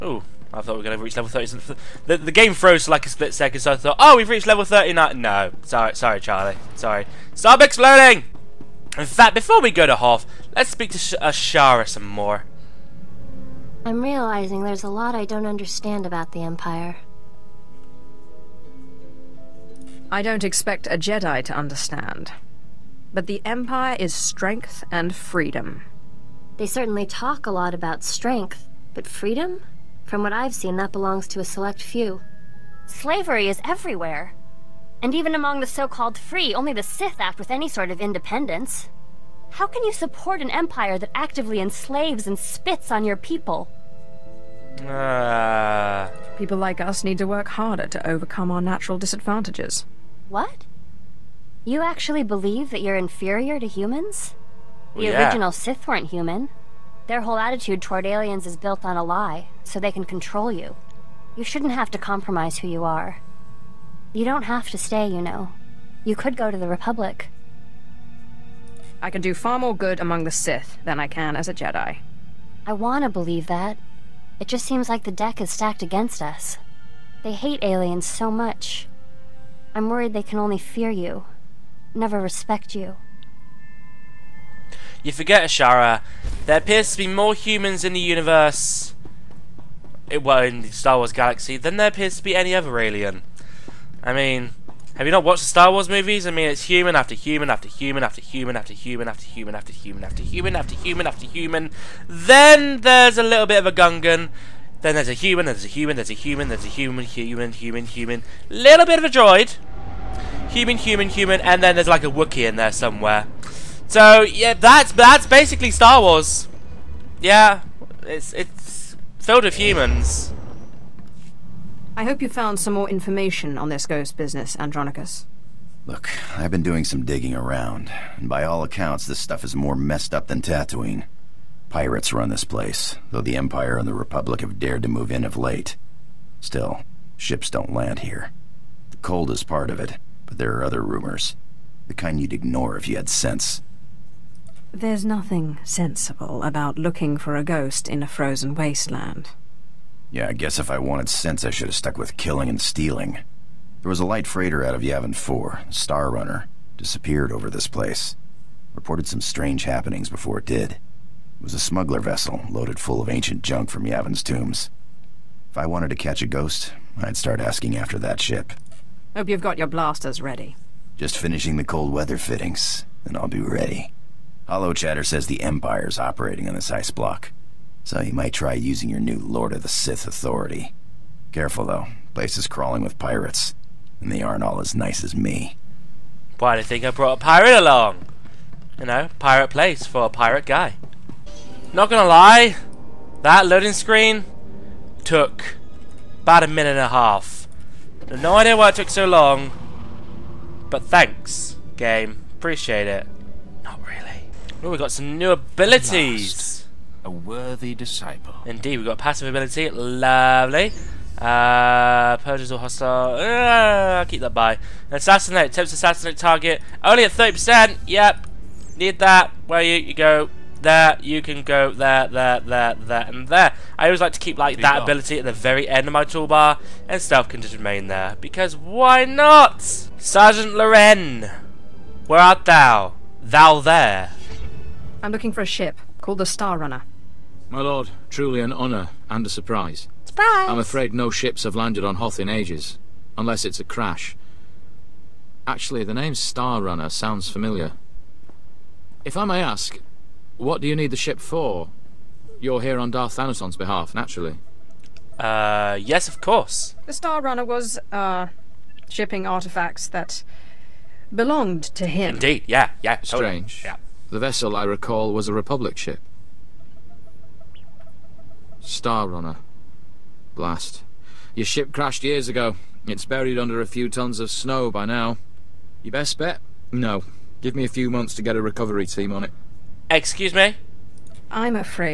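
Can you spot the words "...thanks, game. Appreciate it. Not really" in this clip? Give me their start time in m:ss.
3:20.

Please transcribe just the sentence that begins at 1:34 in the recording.
I mean, have you not watched the Star Wars movies?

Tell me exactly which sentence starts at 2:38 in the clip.
Reported some strange happenings before it did.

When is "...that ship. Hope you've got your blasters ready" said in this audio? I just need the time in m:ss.
2:47.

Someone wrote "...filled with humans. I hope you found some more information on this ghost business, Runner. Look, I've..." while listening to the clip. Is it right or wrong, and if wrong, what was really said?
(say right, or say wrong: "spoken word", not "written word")
wrong: "Andronikos", not "Runner".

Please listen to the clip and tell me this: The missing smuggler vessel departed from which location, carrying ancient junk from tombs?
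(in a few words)
Yavin 4.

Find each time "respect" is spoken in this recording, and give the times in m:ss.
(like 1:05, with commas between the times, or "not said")
1:22.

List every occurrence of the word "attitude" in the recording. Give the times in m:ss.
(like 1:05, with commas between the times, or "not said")
0:57.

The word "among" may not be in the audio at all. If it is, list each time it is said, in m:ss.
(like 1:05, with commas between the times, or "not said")
0:35, 1:09.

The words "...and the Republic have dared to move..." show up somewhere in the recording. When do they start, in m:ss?
2:13.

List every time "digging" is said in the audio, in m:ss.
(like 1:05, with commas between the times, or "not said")
2:07.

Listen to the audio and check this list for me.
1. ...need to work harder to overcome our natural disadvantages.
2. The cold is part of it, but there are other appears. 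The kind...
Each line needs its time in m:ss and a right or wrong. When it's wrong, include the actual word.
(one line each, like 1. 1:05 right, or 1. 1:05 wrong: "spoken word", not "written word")
1. 0:47 right
2. 2:18 wrong: "rumors", not "appears".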